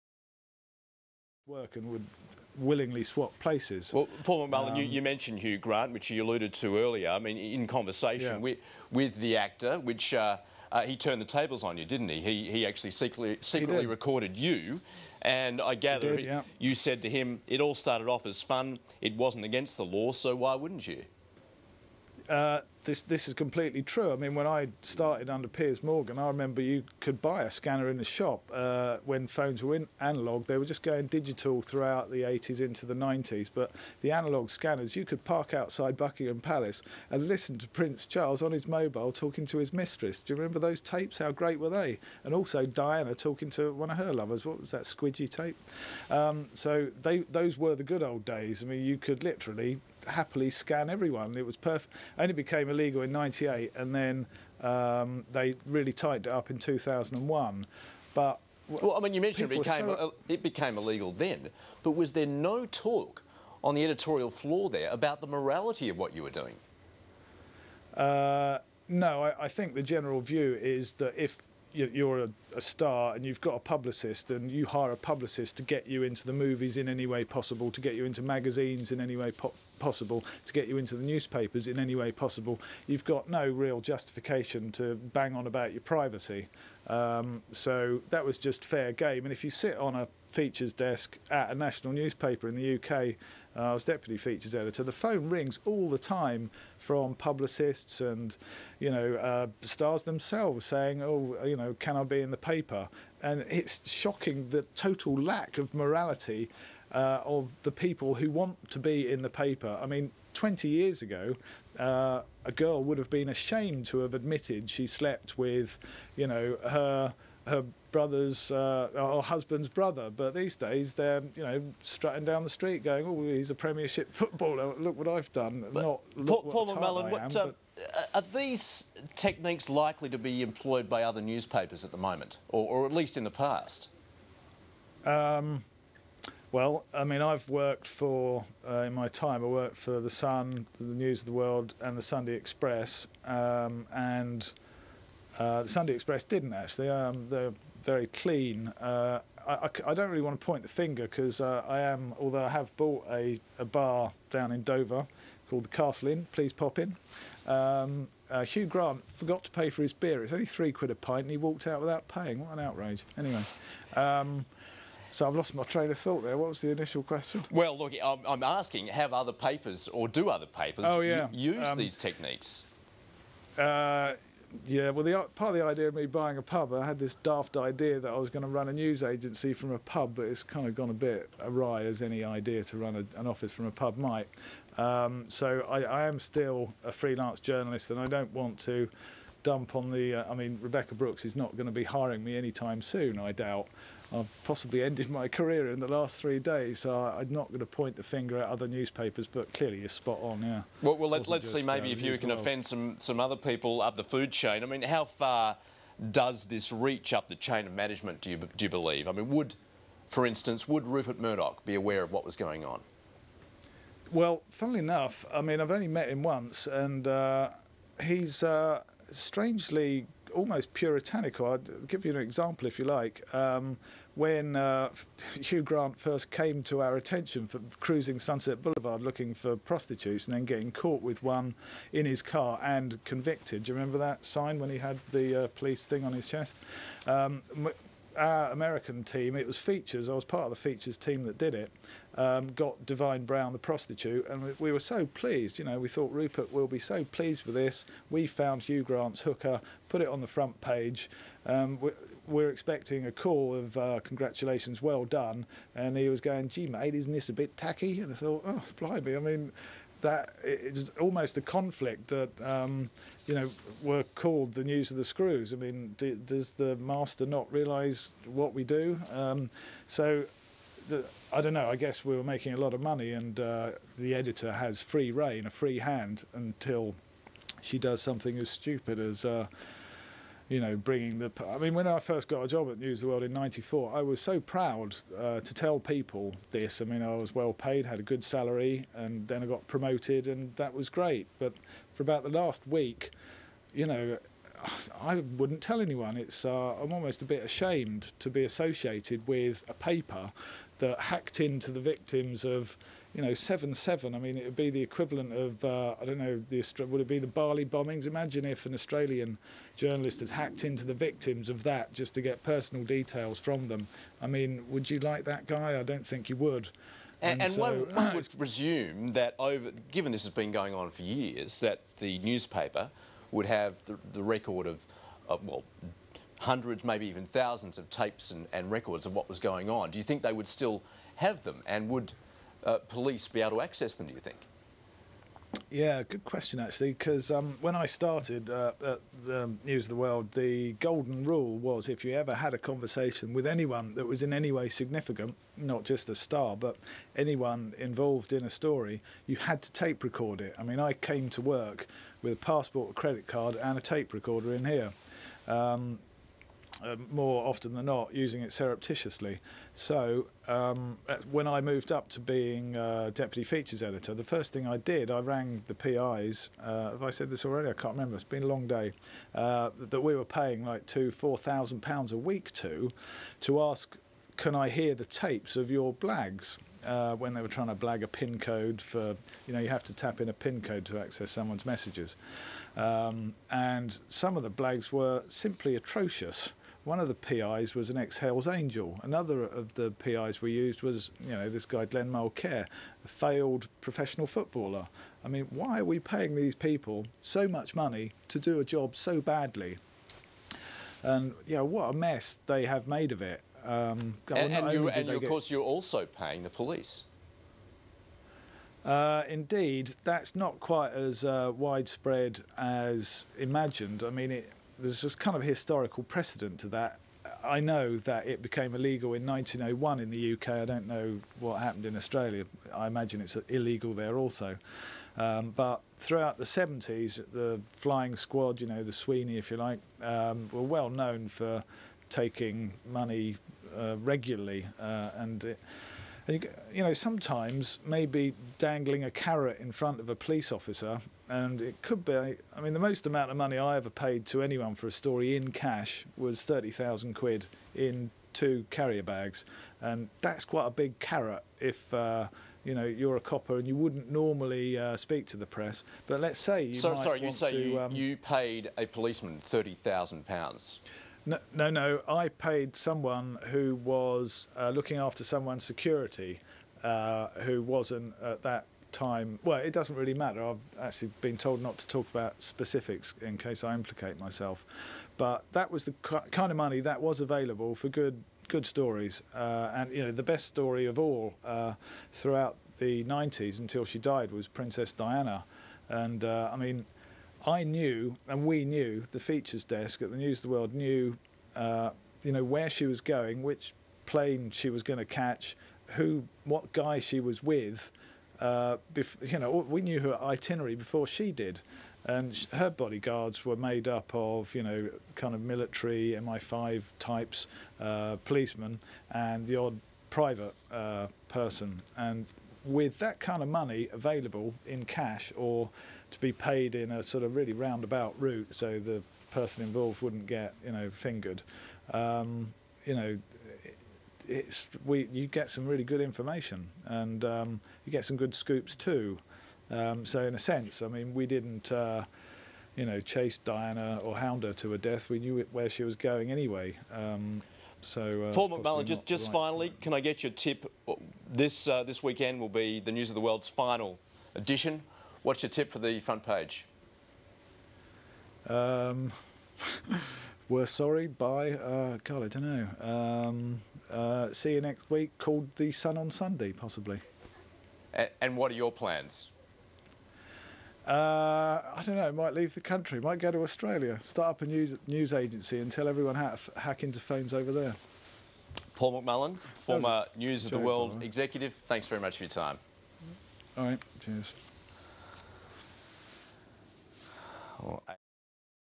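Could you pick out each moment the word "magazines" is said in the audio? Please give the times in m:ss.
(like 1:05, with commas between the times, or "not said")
1:18.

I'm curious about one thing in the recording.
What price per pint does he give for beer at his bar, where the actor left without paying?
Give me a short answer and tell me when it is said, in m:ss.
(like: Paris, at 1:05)
3 quid, at 2:40.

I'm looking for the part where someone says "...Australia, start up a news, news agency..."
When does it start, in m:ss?
9:23.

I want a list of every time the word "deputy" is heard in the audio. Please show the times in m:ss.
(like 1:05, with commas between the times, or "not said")
1:33, 6:03.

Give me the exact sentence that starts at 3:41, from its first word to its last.
i will give you an example if you like.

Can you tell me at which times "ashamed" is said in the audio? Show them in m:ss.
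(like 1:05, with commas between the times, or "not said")
1:53, 4:57.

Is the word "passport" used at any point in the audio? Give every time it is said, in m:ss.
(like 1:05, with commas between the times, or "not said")
5:52.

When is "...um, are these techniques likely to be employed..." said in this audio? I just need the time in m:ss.
2:07.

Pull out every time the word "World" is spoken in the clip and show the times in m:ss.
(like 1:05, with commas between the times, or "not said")
2:21, 4:43, 5:39, 8:10, 9:03, 9:30.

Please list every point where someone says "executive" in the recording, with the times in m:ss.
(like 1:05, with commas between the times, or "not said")
9:31.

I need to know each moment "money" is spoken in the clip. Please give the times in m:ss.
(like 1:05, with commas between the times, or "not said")
4:32, 6:37, 7:12, 7:23, 7:56, 8:33.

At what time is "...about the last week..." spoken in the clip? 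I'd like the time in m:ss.
4:52.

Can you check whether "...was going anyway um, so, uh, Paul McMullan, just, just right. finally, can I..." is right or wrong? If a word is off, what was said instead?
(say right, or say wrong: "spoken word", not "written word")
right.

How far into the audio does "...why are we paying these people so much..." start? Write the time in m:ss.
6:35.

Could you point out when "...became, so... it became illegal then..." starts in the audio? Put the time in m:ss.
0:59.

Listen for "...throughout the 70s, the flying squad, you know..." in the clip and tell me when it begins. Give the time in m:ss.
7:05.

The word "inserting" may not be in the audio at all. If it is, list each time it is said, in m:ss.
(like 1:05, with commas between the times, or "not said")
not said.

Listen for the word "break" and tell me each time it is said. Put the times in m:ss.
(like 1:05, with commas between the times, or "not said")
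not said.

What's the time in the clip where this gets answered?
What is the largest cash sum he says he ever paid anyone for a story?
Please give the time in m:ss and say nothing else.
7:26.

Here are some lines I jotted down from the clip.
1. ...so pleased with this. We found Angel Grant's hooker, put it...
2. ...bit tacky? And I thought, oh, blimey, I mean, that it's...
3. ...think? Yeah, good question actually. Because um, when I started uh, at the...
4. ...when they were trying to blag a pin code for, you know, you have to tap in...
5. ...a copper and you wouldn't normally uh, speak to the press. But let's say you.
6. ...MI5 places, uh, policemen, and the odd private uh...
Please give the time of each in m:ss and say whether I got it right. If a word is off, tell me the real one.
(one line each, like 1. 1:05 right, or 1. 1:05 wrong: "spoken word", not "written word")
1. 4:06 wrong: "Hugh", not "Angel"
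2. 4:17 right
3. 5:34 right
4. 6:17 right
5. 7:33 right
6. 8:26 wrong: "types", not "places".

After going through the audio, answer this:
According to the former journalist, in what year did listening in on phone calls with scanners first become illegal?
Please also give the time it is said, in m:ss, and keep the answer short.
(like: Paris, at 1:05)
1998, at 0:53.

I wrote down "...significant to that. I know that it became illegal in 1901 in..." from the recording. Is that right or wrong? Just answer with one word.
wrong.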